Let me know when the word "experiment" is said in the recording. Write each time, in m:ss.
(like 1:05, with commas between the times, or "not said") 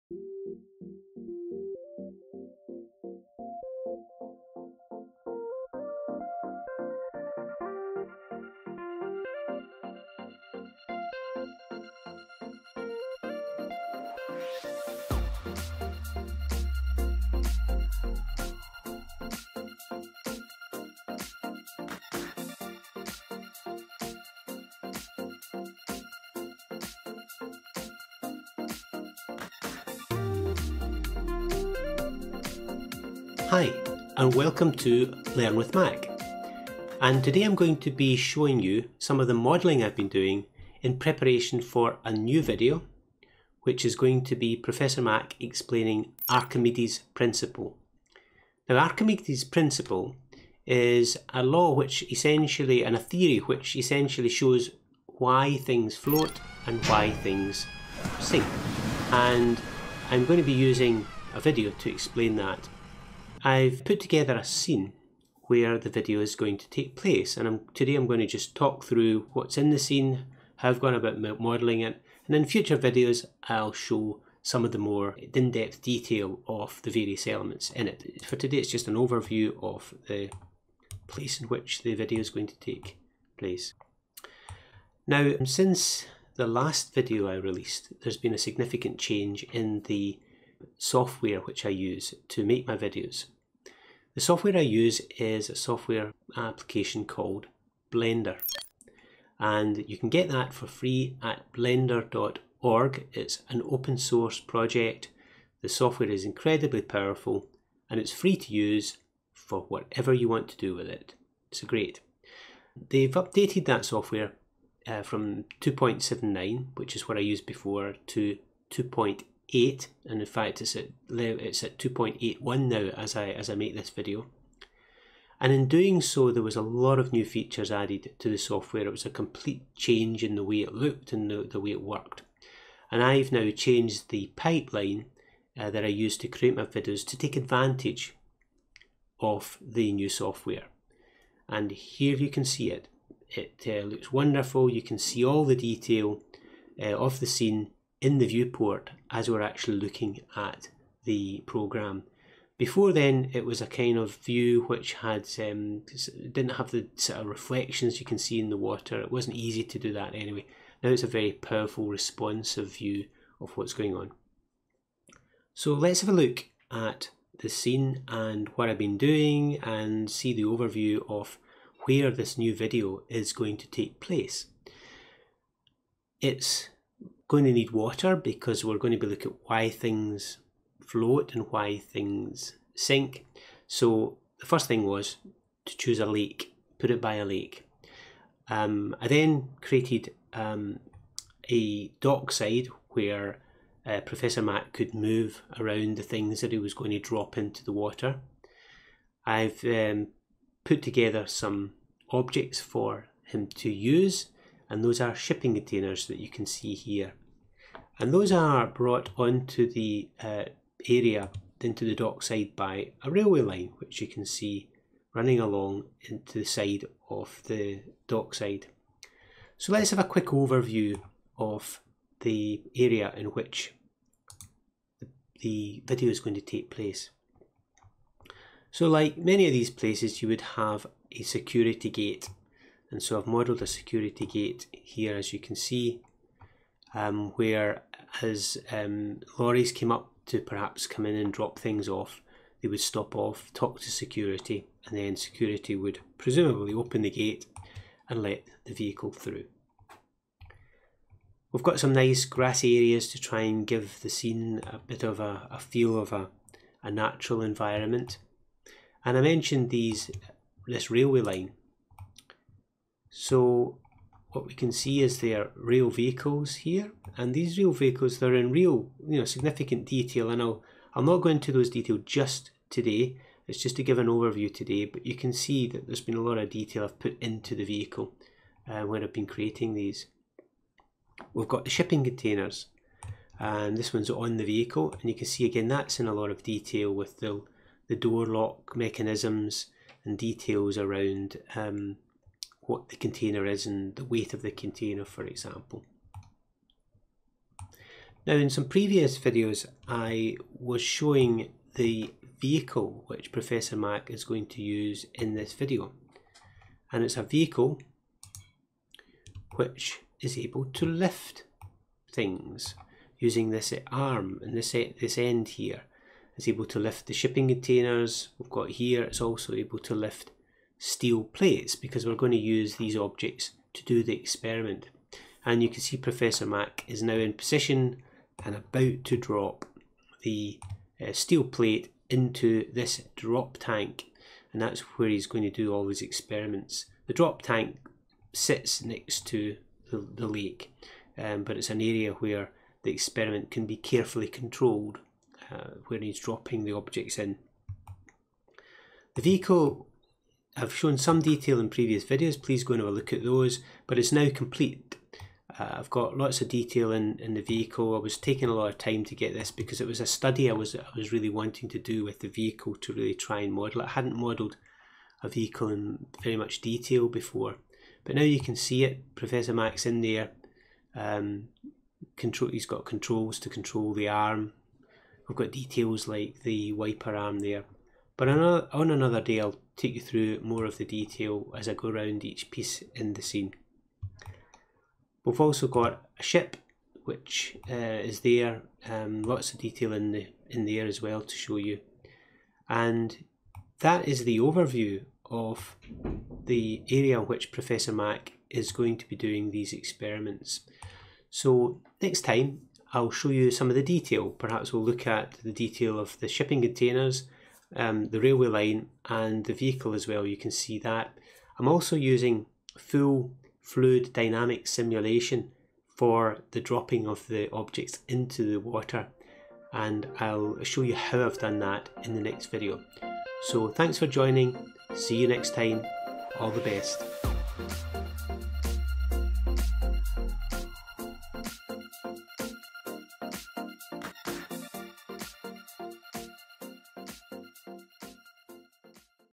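5:24, 5:36, 5:42, 6:39.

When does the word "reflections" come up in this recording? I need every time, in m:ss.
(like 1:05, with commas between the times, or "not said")
2:37.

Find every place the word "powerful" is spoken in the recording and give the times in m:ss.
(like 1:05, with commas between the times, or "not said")
1:46, 2:41.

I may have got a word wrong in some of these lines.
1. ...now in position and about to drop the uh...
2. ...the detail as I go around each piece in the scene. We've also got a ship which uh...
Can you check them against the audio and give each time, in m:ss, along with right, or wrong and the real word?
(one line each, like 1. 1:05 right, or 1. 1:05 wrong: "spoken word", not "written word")
1. 5:27 right
2. 6:20 right.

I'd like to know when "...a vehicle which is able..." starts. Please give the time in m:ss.
5:07.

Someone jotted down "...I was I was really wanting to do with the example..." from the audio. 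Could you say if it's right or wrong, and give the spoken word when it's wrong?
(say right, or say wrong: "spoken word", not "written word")
wrong: "vehicle", not "example".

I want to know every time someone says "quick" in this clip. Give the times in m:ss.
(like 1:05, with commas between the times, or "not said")
3:40.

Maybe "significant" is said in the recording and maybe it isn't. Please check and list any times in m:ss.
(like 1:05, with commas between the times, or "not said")
1:28, 4:29.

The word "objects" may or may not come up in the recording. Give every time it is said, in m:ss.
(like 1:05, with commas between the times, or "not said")
3:22, 5:22, 5:46, 6:57.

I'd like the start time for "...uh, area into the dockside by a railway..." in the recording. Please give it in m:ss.
3:30.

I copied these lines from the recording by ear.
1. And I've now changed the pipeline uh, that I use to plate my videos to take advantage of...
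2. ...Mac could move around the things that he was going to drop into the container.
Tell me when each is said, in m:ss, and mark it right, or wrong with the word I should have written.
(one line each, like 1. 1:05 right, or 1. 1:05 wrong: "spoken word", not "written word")
1. 2:12 wrong: "create", not "plate"
2. 3:14 wrong: "water", not "container".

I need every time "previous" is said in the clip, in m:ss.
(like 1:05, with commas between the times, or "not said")
4:58, 5:51.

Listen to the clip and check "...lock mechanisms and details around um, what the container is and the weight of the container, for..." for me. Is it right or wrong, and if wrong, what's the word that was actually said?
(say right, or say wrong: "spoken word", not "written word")
right.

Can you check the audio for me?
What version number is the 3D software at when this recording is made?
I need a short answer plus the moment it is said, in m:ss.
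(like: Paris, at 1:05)
2.81, at 2:01.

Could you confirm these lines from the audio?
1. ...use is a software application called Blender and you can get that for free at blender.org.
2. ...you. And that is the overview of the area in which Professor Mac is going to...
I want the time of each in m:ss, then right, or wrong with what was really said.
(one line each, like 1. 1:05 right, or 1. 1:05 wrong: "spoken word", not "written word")
1. 1:34 right
2. 6:31 right.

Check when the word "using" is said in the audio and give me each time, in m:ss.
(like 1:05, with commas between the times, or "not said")
1:00, 5:13, 6:51.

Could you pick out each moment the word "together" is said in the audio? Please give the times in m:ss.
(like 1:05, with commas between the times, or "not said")
1:03, 3:20.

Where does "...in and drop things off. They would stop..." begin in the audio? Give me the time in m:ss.
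4:01.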